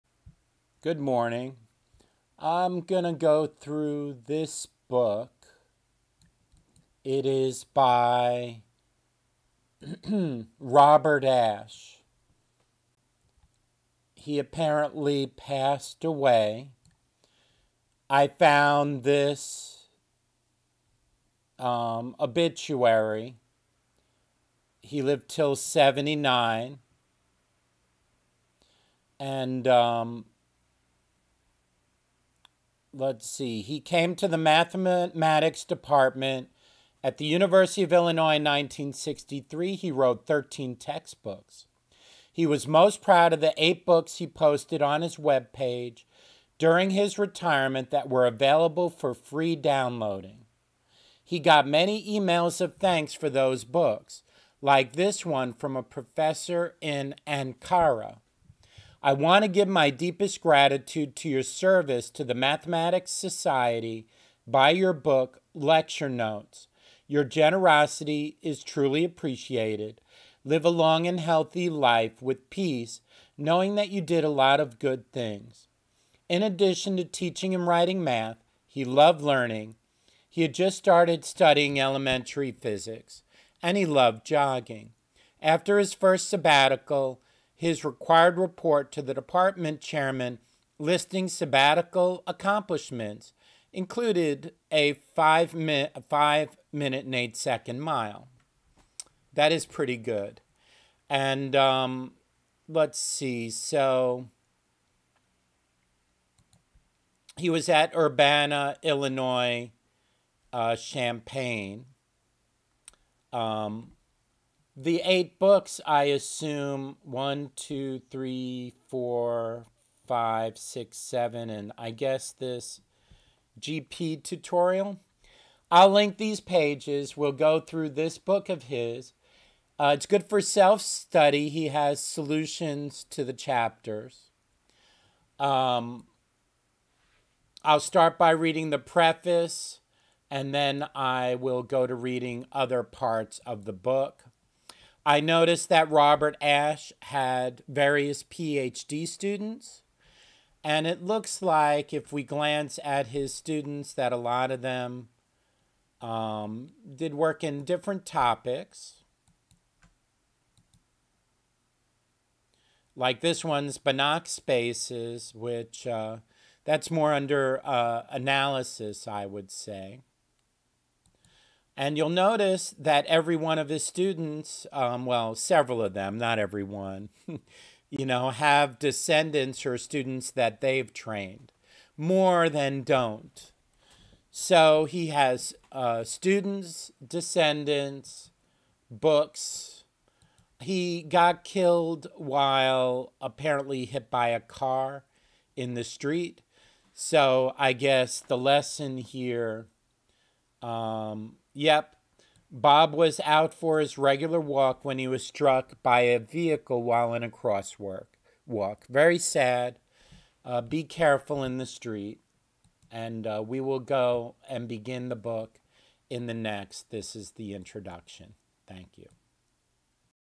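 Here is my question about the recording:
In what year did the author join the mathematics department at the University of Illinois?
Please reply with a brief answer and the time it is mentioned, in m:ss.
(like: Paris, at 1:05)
1963, at 0:38.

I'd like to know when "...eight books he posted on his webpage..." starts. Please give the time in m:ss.
0:43.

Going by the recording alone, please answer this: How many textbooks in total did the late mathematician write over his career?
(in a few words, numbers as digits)
13.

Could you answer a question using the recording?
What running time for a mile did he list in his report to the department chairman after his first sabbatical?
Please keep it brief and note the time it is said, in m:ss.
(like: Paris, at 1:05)
5 minutes 8 seconds, at 1:36.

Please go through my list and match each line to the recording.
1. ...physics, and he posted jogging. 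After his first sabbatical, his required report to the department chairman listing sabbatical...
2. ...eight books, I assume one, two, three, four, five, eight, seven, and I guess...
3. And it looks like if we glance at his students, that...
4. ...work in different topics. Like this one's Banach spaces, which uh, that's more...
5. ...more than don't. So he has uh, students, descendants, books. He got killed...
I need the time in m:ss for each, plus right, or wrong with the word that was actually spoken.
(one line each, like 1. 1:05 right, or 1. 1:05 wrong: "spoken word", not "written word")
1. 1:22 wrong: "loved", not "posted"
2. 1:55 wrong: "six", not "eight"
3. 2:30 right
4. 2:37 right
5. 3:01 right.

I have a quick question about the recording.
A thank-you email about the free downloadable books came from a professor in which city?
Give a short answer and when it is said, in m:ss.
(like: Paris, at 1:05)
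Ankara, at 0:57.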